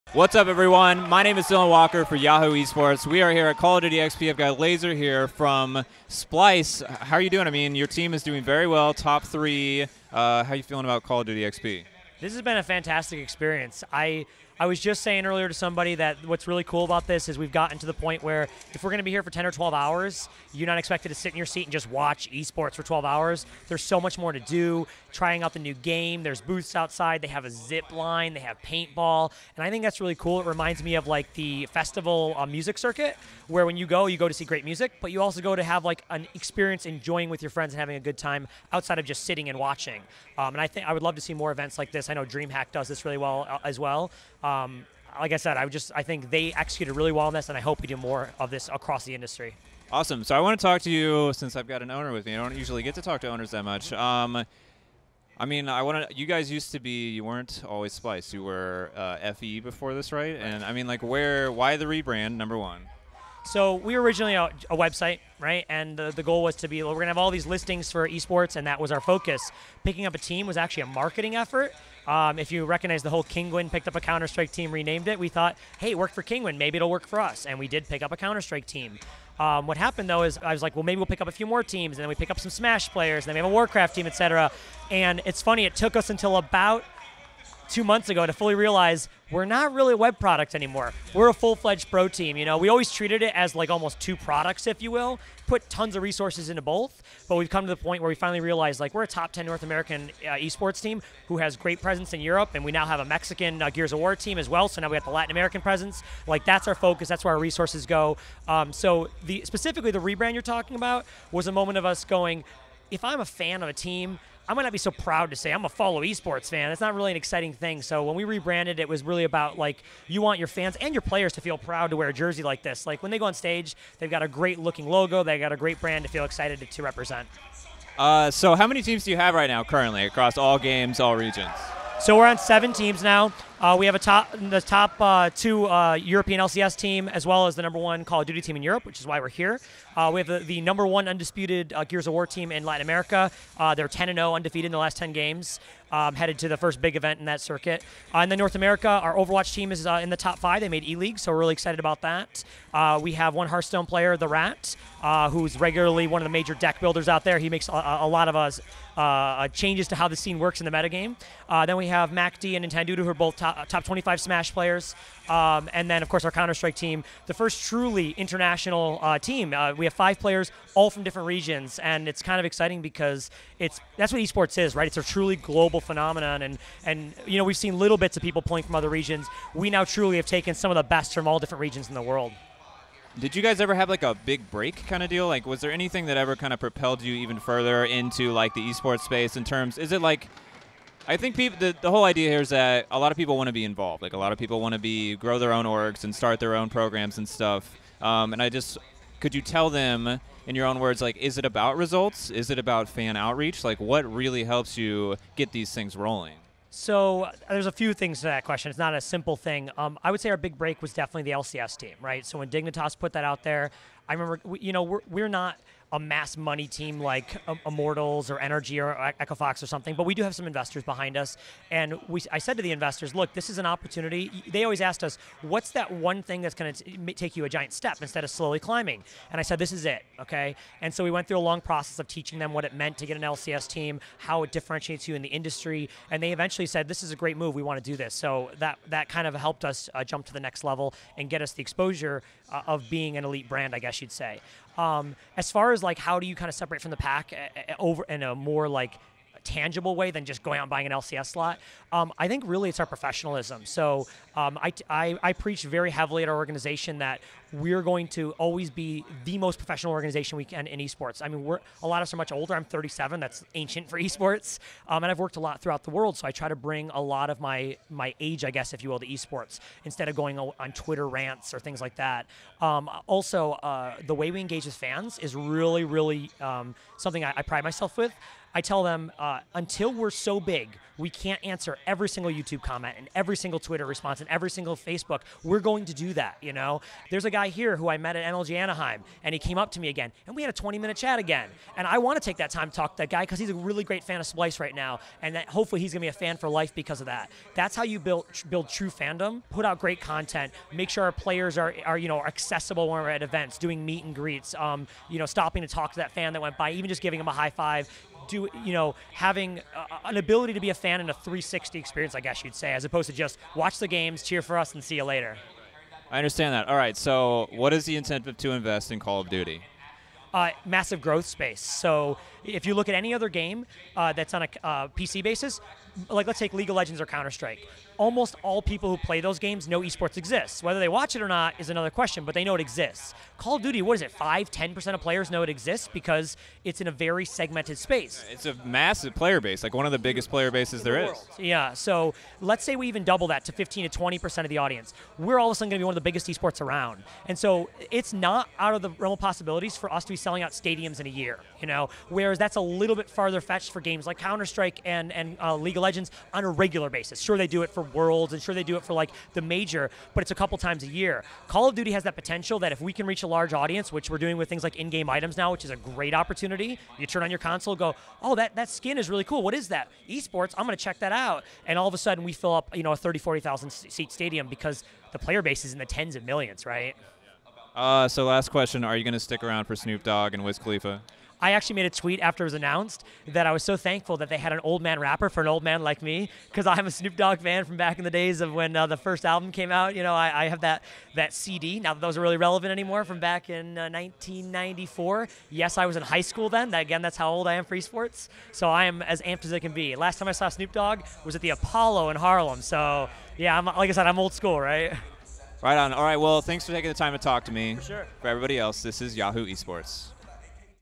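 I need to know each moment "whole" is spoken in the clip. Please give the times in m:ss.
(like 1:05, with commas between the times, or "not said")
1:13, 3:11.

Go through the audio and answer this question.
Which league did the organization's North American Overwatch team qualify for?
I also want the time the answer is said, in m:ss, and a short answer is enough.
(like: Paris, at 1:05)
E League, at 2:30.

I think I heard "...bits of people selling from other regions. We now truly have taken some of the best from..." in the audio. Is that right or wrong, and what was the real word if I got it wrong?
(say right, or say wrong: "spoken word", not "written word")
wrong: "playing", not "selling".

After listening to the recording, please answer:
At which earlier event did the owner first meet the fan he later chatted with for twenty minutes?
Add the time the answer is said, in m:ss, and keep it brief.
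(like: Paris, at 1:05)
MLG Anaheim, at 4:48.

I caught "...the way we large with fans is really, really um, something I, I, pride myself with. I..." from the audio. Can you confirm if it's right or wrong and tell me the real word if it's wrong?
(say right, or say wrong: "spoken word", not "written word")
wrong: "engage", not "large".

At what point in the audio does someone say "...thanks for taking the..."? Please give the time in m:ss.
6:46.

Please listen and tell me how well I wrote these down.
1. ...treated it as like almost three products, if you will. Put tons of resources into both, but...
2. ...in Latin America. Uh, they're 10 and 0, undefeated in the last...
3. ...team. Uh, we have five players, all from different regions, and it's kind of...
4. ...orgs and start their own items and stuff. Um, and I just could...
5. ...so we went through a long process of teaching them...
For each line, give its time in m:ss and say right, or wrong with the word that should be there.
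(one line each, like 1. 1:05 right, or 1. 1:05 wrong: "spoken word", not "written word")
1. 1:32 wrong: "two", not "three"
2. 2:22 right
3. 2:49 right
4. 3:15 wrong: "programs", not "items"
5. 3:50 right.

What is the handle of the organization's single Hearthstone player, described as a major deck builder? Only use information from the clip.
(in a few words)
the Rat.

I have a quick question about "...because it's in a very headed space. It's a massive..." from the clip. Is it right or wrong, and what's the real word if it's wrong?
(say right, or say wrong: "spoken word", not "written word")
wrong: "segmented", not "headed".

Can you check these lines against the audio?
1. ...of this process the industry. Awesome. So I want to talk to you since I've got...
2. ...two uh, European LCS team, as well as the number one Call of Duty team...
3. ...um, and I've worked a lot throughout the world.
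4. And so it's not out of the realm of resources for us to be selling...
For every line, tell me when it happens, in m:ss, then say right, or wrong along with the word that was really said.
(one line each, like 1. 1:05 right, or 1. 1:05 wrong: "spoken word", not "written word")
1. 0:48 wrong: "across", not "process"
2. 2:15 right
3. 4:24 right
4. 5:47 wrong: "possibilities", not "resources".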